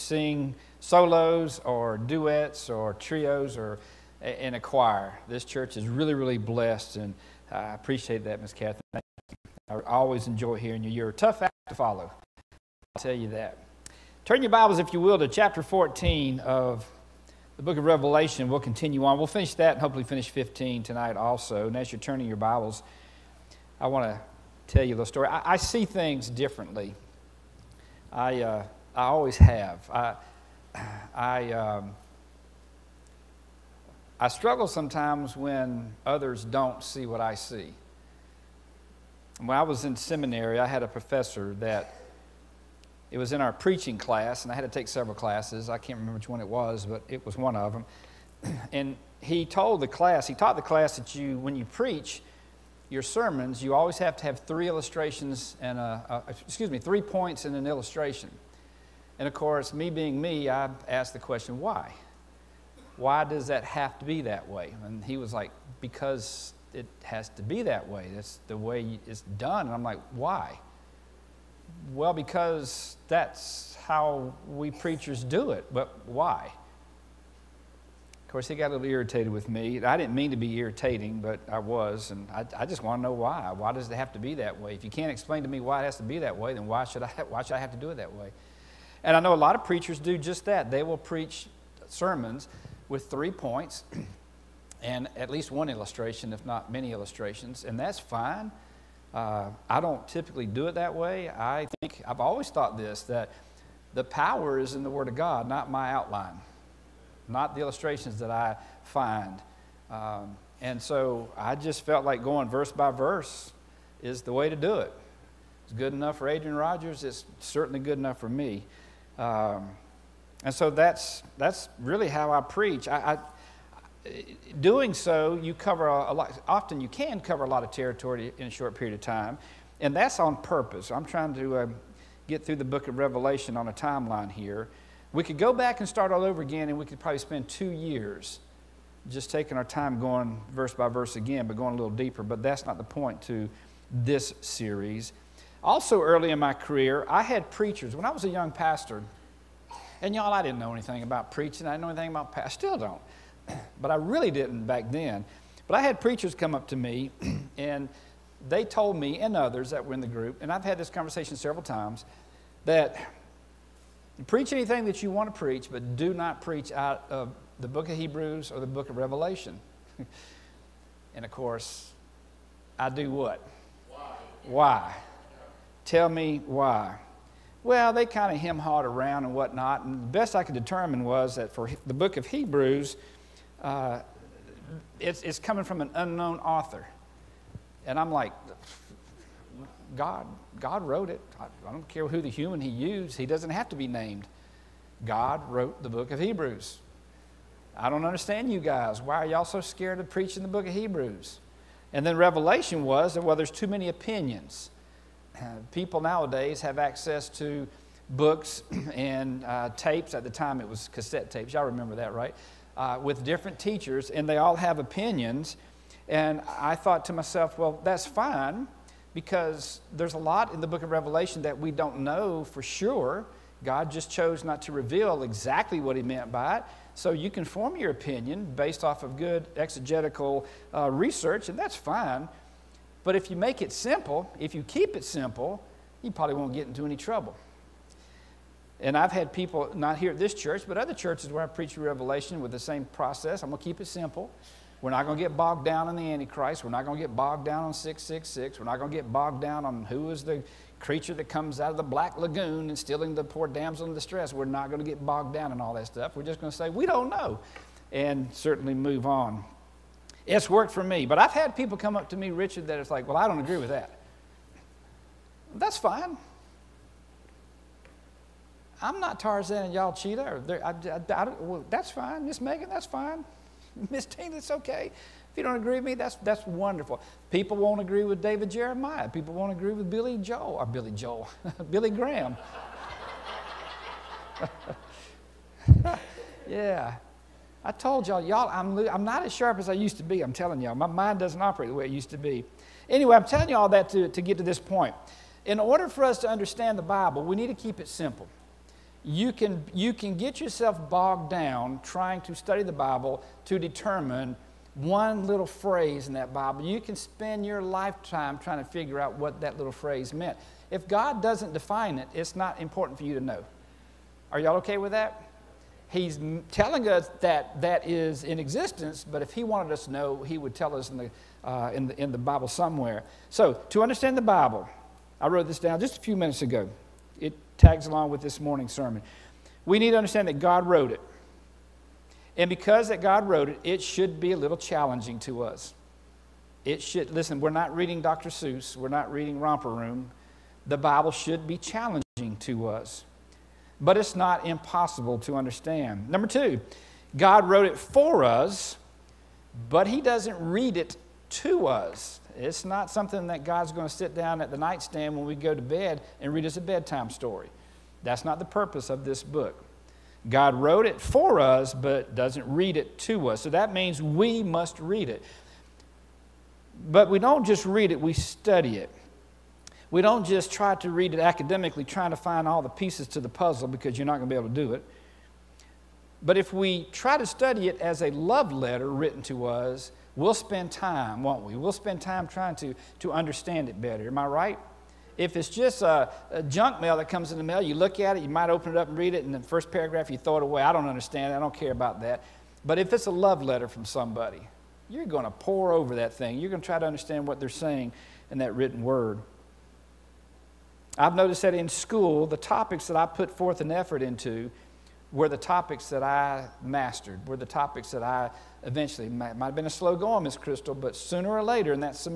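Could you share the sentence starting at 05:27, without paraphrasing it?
It tags along with this morning's sermon.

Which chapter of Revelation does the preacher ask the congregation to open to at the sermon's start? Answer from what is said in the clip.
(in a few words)
14.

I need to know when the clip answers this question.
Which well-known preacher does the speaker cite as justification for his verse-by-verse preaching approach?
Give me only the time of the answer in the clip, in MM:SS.
01:56.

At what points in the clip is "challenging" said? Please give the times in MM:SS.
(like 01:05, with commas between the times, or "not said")
05:34, 05:41.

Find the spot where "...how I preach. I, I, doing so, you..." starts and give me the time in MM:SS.
02:02.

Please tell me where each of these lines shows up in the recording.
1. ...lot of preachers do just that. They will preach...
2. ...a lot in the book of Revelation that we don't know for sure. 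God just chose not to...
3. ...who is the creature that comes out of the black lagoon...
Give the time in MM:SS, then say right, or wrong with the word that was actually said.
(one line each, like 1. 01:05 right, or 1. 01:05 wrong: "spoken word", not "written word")
1. 01:29 right
2. 03:40 right
3. 04:09 right.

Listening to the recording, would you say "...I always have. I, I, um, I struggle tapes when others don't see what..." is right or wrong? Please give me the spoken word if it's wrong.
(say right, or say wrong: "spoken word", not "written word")
wrong: "sometimes", not "tapes".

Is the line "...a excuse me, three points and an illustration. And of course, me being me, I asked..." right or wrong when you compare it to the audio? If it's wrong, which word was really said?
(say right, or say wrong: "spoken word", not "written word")
right.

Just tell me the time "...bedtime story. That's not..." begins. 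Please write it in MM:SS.
05:56.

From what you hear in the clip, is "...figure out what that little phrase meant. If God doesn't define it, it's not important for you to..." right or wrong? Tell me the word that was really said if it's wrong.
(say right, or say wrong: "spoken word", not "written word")
right.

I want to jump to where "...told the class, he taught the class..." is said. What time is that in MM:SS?
00:49.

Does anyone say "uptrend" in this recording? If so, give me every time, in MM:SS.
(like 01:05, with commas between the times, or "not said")
not said.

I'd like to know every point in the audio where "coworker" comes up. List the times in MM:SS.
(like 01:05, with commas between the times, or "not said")
not said.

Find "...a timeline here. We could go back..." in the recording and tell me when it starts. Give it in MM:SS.
02:13.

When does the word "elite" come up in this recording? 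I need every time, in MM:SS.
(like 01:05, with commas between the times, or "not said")
not said.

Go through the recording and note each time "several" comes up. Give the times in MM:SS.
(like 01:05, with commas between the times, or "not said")
00:44, 02:41.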